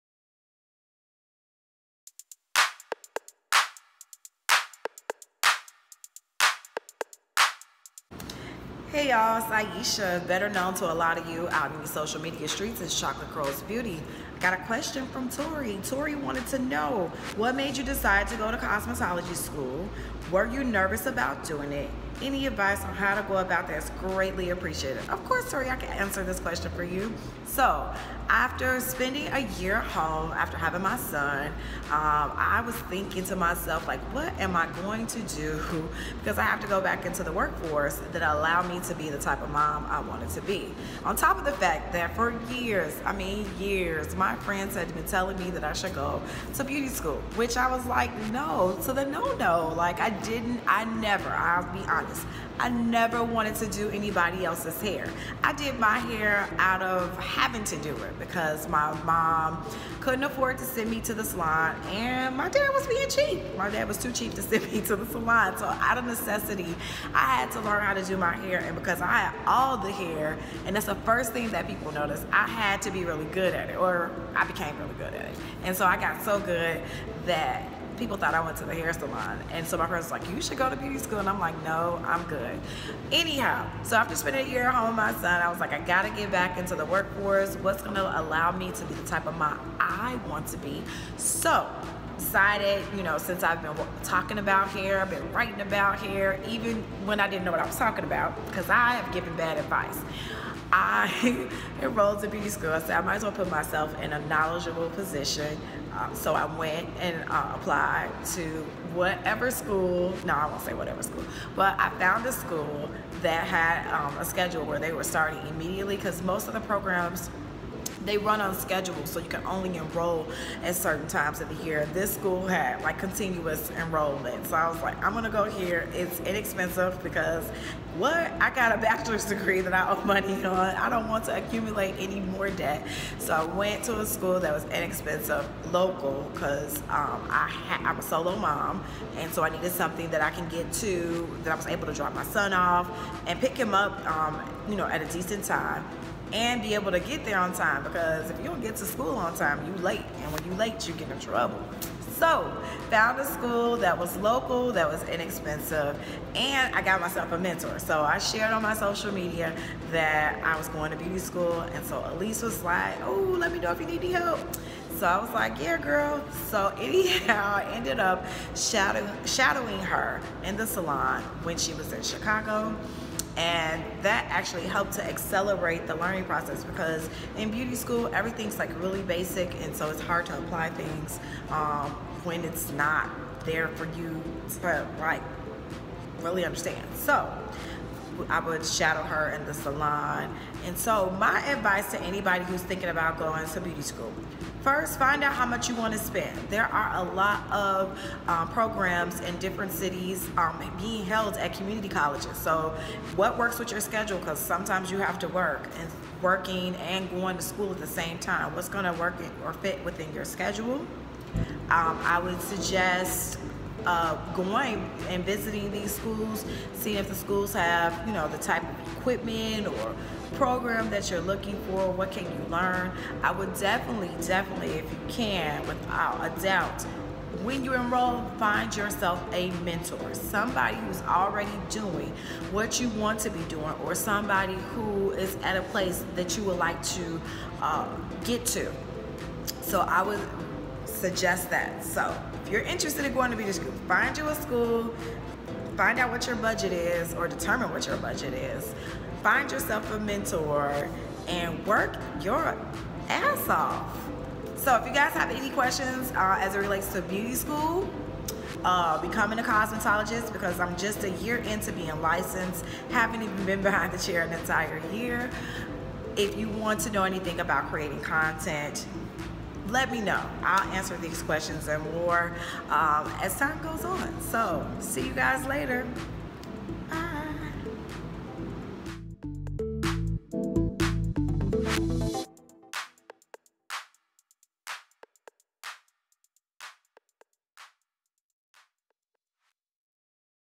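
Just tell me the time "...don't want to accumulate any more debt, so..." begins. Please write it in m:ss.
2:10.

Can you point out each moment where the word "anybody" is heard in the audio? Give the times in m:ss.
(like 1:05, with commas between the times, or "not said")
0:53, 3:12.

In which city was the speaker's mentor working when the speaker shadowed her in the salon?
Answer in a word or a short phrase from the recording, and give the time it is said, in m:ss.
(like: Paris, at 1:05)
Chicago, at 2:52.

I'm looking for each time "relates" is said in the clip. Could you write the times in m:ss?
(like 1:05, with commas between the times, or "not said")
4:16.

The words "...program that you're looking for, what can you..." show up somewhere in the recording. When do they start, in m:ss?
3:40.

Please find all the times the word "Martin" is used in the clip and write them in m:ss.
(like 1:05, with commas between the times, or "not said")
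not said.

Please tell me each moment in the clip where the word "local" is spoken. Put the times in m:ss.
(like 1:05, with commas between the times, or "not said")
2:15, 2:34.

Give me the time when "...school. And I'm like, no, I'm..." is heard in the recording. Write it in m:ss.
1:20.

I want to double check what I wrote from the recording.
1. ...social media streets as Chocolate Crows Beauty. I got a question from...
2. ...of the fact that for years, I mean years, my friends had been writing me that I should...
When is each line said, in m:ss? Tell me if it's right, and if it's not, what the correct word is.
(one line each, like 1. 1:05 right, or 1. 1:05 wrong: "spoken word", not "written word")
1. 0:11 right
2. 0:41 wrong: "telling", not "writing".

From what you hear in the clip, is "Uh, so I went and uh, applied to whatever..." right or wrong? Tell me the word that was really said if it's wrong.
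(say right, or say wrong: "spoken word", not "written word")
right.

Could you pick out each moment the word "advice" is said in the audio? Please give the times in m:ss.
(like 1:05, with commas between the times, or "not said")
0:22, 1:39, 3:11.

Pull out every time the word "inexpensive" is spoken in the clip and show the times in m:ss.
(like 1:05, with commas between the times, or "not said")
2:06, 2:14, 2:35.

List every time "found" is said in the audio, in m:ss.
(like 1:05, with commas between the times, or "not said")
1:51, 2:32.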